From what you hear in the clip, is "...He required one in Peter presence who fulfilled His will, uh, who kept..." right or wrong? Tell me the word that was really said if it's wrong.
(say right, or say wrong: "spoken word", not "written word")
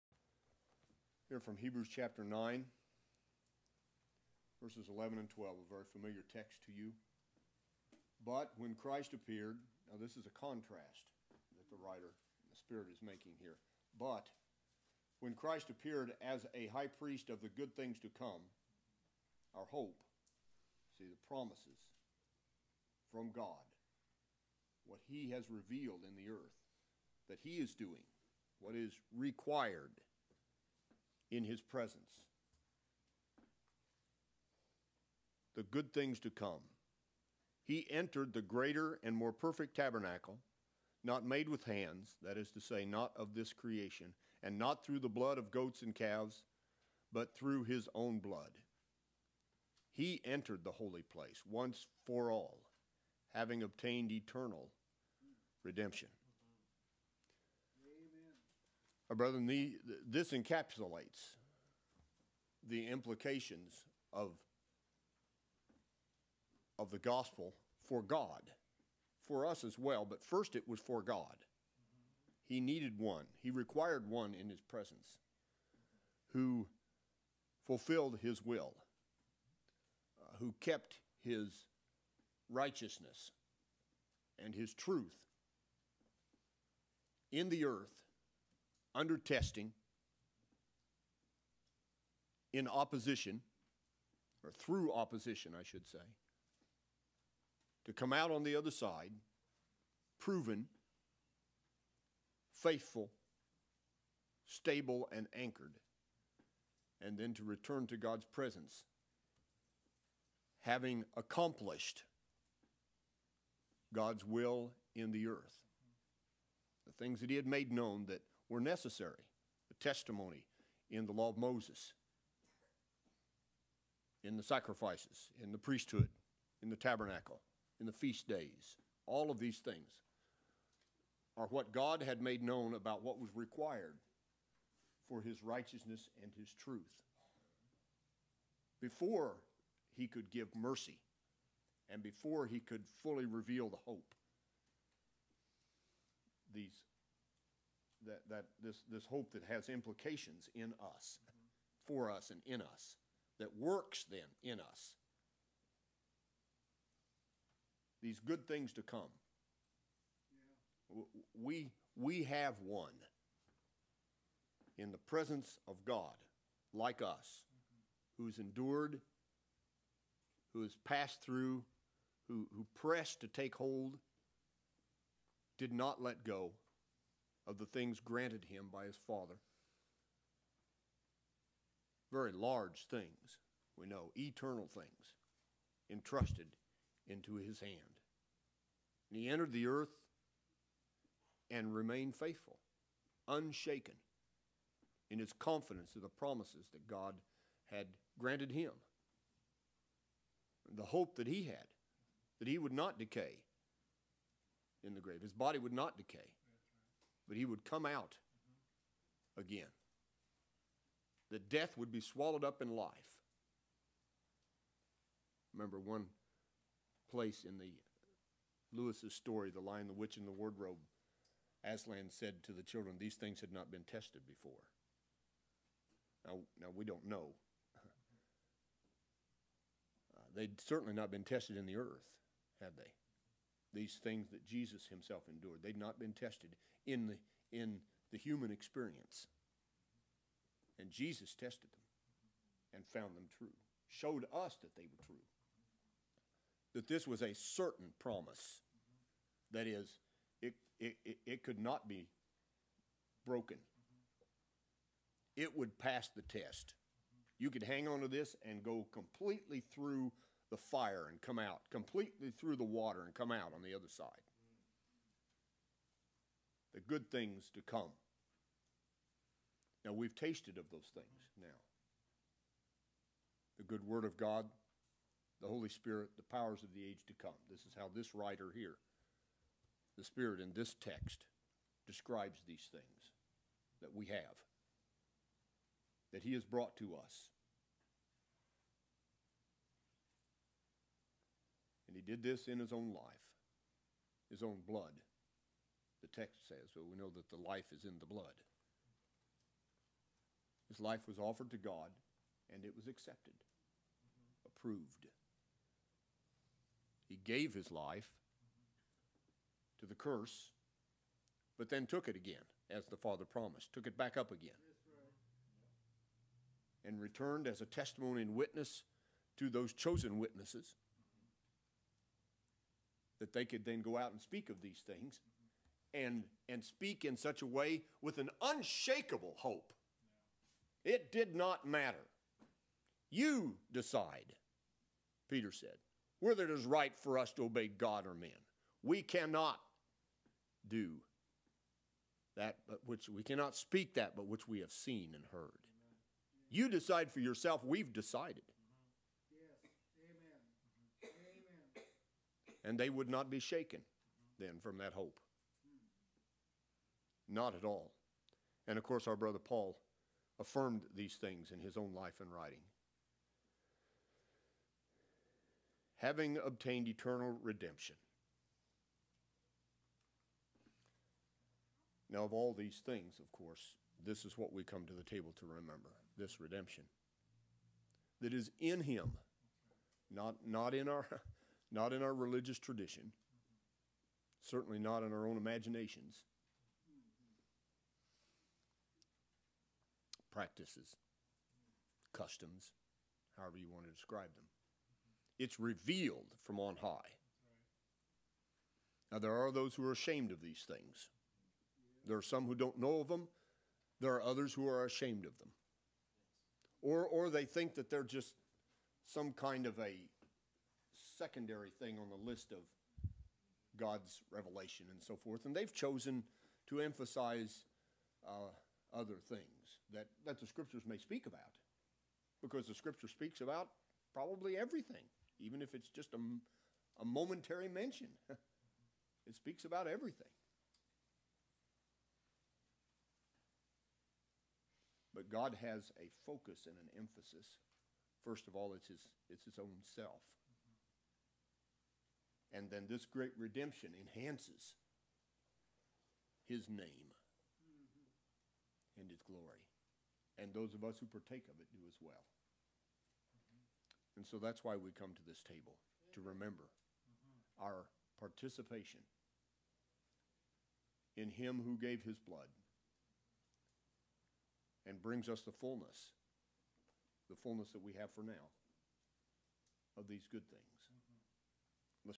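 wrong: "His", not "Peter".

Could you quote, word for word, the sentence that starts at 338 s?
We cannot do that but which we cannot speak that but which we have seen and heard.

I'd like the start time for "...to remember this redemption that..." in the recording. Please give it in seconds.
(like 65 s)
375 s.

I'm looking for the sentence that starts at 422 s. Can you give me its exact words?
Because the scripture speaks about probably everything, even if it's just a, a momentary mention.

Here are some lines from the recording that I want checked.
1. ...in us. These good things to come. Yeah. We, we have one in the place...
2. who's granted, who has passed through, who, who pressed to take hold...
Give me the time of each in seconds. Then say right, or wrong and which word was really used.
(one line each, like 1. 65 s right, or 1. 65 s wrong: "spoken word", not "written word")
1. 154 s wrong: "presence", not "place"
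2. 168 s wrong: "endured", not "granted".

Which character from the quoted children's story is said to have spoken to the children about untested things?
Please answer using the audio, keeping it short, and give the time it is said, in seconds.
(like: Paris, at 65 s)
Aslan, at 221 s.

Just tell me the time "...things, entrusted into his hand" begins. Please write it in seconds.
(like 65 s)
184 s.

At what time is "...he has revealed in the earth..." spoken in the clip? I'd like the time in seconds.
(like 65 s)
25 s.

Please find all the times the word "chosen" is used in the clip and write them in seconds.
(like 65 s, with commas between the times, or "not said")
319 s, 415 s.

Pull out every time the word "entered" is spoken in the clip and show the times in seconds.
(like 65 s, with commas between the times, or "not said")
37 s, 50 s, 189 s.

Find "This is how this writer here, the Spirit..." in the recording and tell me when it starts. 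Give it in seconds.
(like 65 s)
277 s.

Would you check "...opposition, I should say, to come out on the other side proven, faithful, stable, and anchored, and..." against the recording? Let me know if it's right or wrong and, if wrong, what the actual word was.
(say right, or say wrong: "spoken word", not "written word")
right.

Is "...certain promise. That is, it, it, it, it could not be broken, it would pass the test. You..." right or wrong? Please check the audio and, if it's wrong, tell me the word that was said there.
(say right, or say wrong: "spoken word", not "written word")
right.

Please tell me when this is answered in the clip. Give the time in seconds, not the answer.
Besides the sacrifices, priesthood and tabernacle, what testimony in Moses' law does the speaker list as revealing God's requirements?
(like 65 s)
127 s.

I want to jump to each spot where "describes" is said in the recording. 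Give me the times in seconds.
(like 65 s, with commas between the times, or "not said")
281 s, 393 s.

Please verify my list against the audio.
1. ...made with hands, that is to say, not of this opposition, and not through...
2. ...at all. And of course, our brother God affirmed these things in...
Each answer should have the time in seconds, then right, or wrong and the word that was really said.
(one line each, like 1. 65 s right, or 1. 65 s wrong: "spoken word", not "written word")
1. 41 s wrong: "creation", not "opposition"
2. 357 s wrong: "Paul", not "God".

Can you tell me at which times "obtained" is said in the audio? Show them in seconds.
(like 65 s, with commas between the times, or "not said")
53 s, 366 s.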